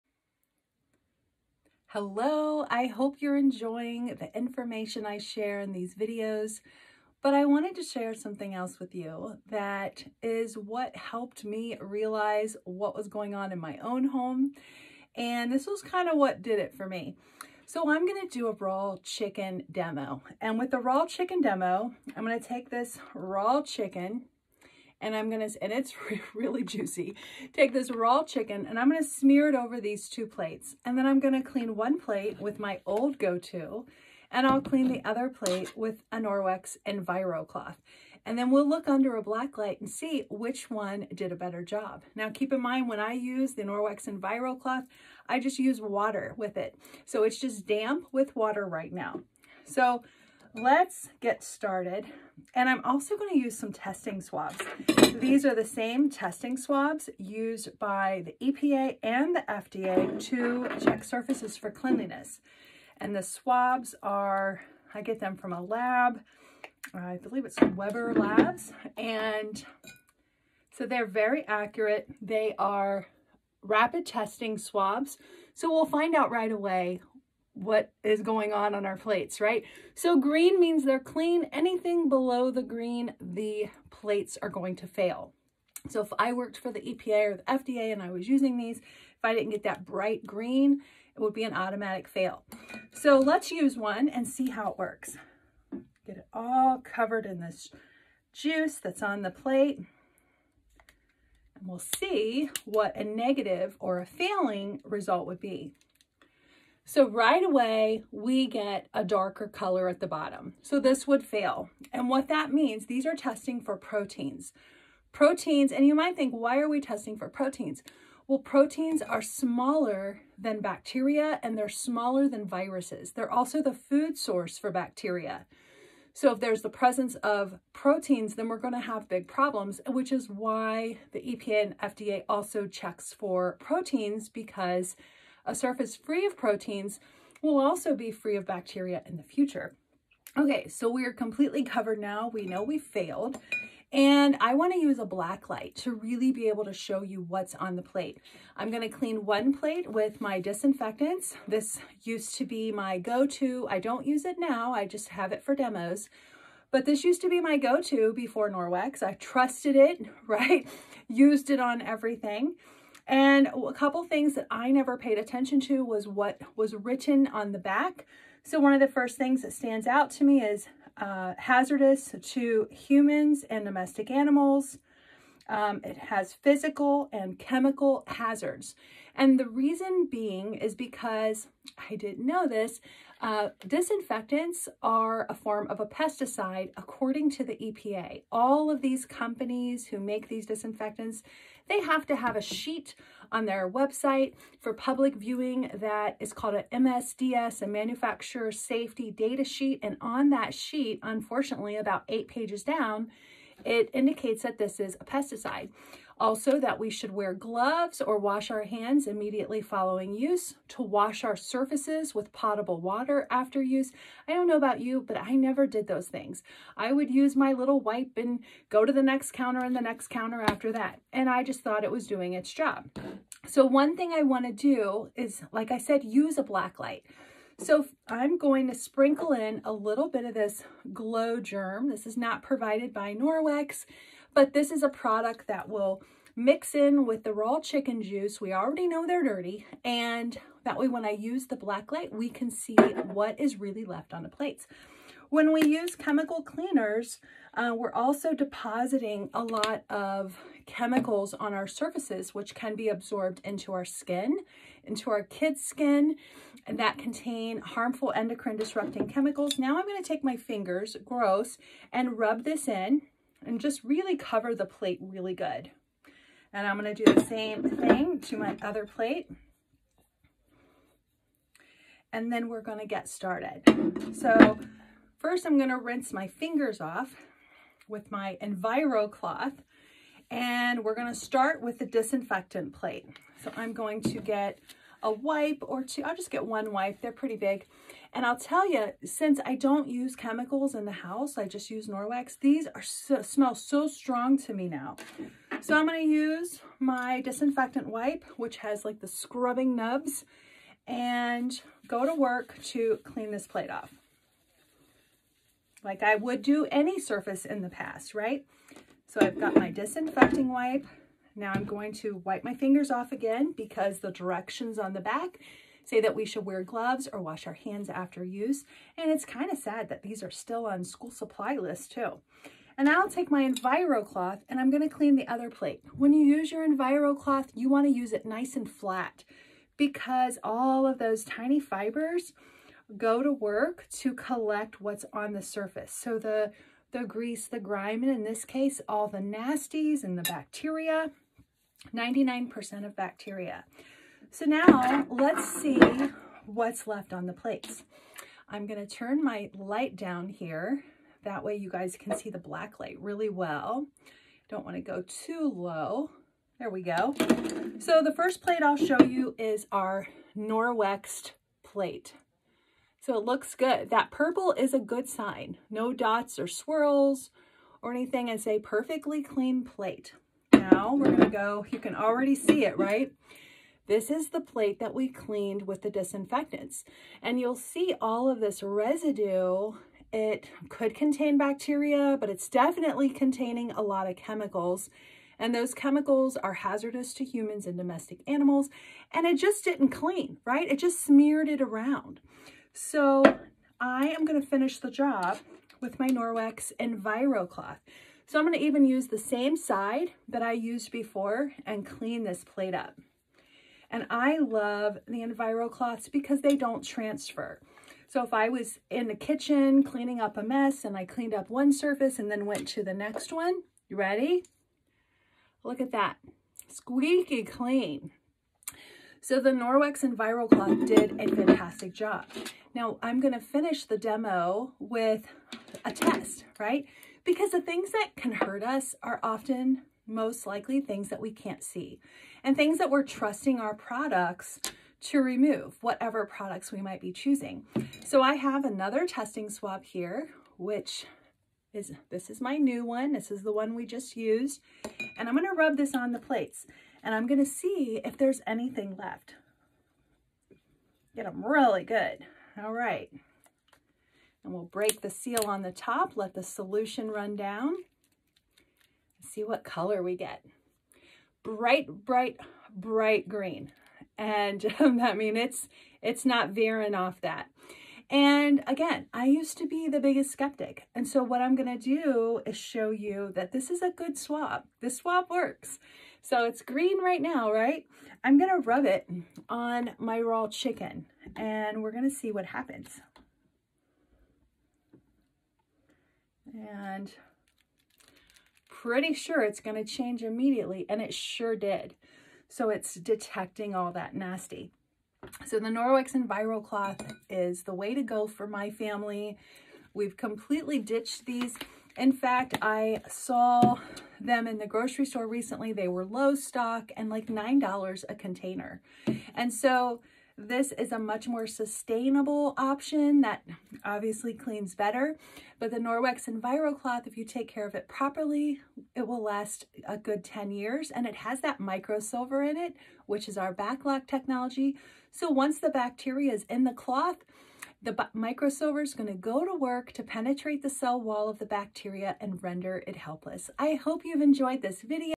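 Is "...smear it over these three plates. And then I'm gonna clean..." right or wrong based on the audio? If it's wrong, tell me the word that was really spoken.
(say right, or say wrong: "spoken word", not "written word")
wrong: "two", not "three".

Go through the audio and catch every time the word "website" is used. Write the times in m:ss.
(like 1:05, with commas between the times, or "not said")
3:13.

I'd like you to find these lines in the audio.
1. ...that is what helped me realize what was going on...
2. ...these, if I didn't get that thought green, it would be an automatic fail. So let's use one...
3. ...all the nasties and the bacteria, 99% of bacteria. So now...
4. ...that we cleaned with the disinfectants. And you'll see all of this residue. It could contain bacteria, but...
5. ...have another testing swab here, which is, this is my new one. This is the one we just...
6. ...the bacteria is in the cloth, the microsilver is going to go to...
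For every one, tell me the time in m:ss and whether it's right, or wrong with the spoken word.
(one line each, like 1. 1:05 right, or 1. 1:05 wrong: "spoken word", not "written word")
1. 0:09 right
2. 1:28 wrong: "bright", not "thought"
3. 5:38 right
4. 6:14 right
5. 7:18 right
6. 8:45 right.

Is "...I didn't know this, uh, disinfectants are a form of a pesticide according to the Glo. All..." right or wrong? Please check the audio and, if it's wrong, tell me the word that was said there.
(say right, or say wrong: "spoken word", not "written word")
wrong: "EPA", not "Glo".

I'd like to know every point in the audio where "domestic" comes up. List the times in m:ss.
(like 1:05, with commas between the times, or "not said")
2:53, 6:27.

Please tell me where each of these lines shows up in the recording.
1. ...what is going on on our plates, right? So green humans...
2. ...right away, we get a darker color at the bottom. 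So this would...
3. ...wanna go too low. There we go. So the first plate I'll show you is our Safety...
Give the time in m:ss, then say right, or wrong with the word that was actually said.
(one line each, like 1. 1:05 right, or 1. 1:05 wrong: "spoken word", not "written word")
1. 1:17 wrong: "means", not "humans"
2. 1:47 right
3. 5:54 wrong: "Norwex", not "Safety".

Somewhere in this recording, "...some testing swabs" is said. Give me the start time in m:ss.
0:53.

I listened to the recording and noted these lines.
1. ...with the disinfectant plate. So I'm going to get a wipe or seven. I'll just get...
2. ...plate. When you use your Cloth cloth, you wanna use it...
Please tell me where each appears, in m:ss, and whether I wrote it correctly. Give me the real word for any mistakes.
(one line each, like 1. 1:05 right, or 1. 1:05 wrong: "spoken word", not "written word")
1. 4:41 wrong: "two", not "seven"
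2. 5:25 wrong: "Enviro", not "Cloth".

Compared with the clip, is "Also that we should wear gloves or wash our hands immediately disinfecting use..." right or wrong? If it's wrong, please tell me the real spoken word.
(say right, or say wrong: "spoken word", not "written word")
wrong: "following", not "disinfecting".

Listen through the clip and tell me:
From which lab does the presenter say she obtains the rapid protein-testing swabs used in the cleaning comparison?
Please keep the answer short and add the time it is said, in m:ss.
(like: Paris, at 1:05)
Weber Labs, at 1:07.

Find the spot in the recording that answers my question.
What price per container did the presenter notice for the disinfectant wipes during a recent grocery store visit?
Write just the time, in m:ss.
8:27.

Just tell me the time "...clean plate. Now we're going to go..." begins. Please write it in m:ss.
6:09.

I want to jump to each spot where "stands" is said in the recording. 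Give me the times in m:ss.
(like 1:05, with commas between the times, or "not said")
2:49.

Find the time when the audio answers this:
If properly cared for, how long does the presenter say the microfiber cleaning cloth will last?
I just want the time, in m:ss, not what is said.
8:39.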